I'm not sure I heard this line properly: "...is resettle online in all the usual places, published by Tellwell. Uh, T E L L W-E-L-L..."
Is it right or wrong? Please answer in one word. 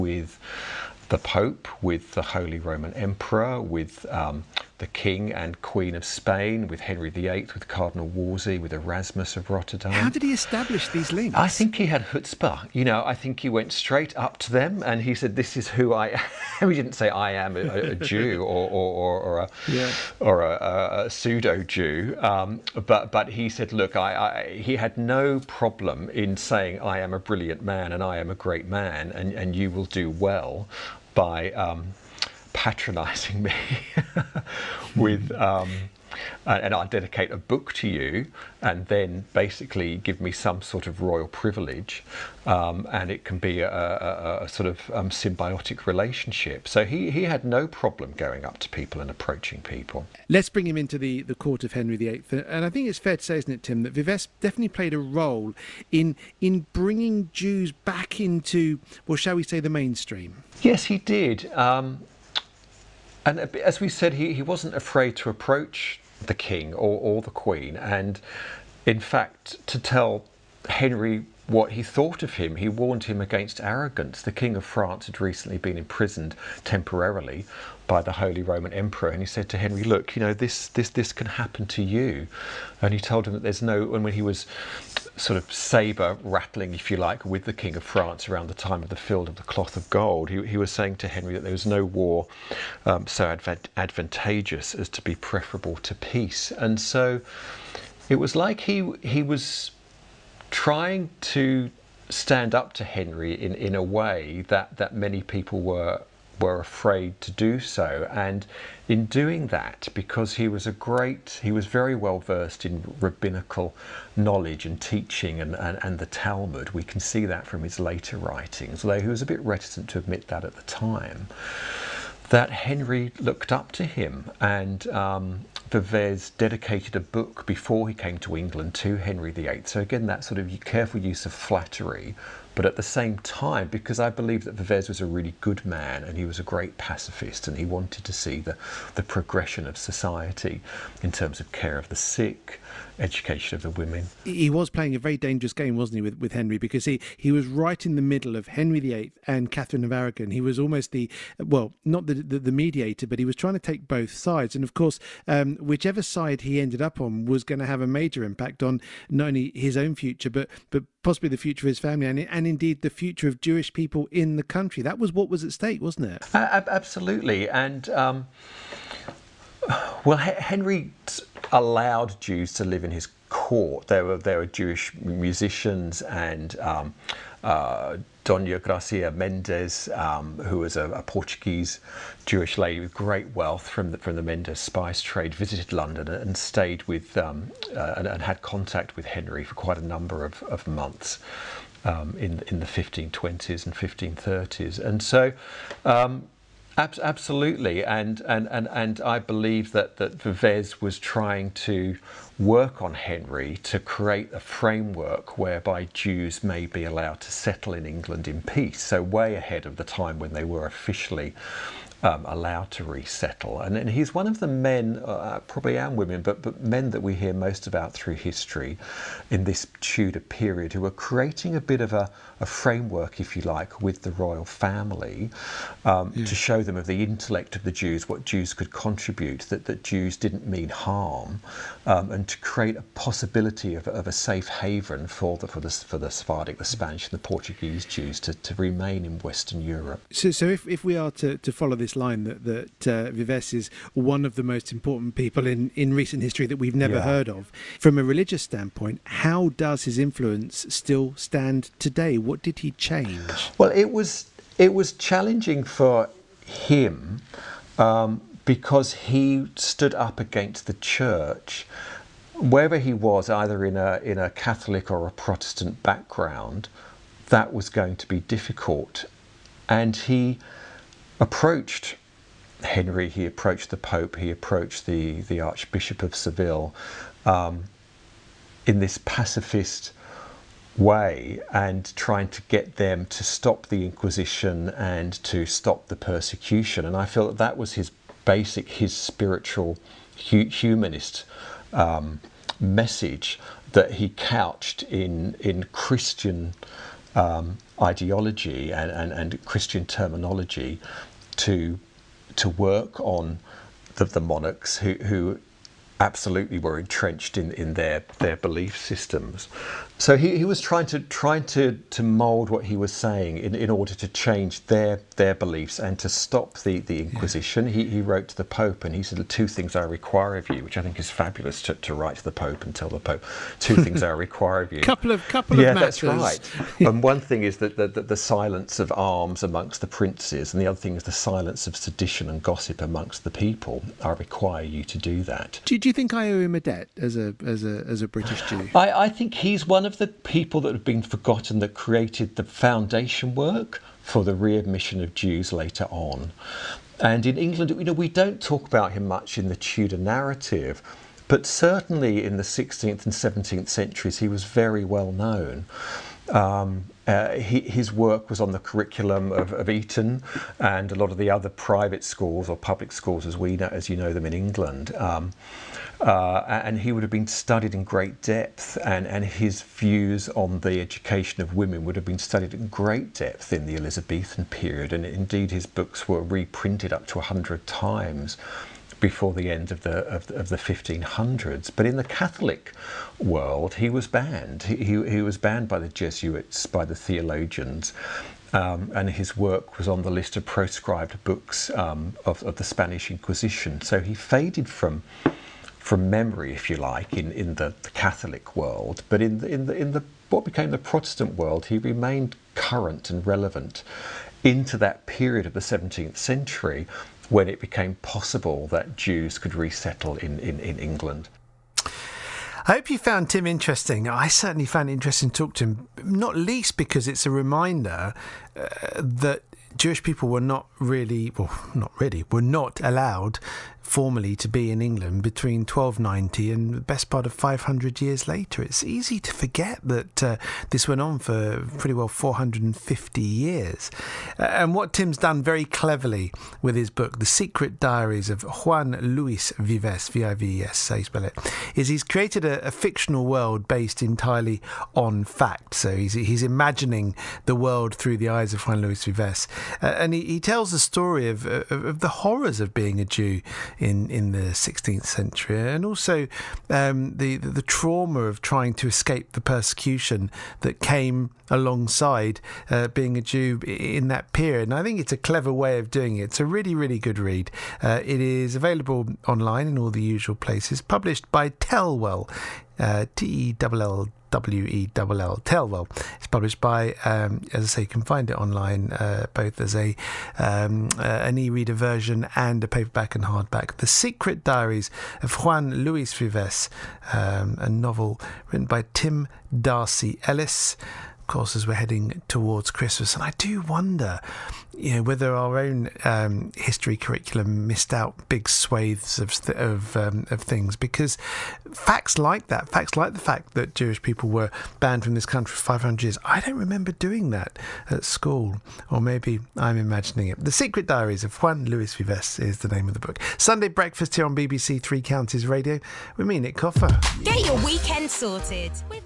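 wrong.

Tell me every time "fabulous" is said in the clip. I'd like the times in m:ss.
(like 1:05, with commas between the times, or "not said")
5:21.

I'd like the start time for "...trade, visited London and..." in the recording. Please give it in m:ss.
3:05.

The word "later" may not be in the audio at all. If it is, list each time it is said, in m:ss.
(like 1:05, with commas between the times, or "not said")
1:57, 5:45, 7:08.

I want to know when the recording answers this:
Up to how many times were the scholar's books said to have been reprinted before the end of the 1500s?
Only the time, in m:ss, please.
6:17.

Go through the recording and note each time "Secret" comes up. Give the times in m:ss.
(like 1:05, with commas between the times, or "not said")
7:17, 8:03, 8:30.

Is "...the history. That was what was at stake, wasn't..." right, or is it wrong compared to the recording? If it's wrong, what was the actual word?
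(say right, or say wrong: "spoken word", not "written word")
wrong: "country", not "history".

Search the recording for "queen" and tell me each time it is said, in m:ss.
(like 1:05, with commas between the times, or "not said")
0:05, 1:07.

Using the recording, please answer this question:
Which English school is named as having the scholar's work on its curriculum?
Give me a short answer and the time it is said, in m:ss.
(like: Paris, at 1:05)
Eton, at 5:59.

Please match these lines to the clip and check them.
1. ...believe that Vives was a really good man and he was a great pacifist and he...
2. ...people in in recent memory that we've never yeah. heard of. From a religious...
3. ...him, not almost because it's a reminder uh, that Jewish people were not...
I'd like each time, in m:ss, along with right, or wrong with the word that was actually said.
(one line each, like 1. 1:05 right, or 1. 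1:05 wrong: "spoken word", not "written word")
1. 2:14 right
2. 4:05 wrong: "history", not "memory"
3. 6:55 wrong: "least", not "almost".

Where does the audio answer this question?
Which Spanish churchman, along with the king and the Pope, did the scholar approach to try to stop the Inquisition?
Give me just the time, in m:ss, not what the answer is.
4:35.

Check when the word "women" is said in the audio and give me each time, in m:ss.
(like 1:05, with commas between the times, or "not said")
2:23, 3:35, 6:11.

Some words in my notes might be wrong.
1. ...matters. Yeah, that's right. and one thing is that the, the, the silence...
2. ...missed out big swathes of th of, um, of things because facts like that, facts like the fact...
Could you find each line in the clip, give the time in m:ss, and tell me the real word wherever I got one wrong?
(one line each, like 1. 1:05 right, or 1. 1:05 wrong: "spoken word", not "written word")
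1. 5:25 right
2. 8:17 right.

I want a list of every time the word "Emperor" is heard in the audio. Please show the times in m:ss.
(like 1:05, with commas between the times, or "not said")
0:02, 1:18.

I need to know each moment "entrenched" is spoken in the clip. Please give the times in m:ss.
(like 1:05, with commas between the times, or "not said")
5:06.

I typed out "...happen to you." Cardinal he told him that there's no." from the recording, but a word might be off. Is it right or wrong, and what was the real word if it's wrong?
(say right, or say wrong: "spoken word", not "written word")
wrong: "And", not "Cardinal".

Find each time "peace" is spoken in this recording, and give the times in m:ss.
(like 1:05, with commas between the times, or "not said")
1:35, 3:28.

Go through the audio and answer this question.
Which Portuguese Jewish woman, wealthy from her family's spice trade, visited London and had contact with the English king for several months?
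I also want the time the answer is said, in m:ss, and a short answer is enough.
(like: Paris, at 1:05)
Dona Gracia Mendes, at 2:58.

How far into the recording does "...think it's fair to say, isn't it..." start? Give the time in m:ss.
0:52.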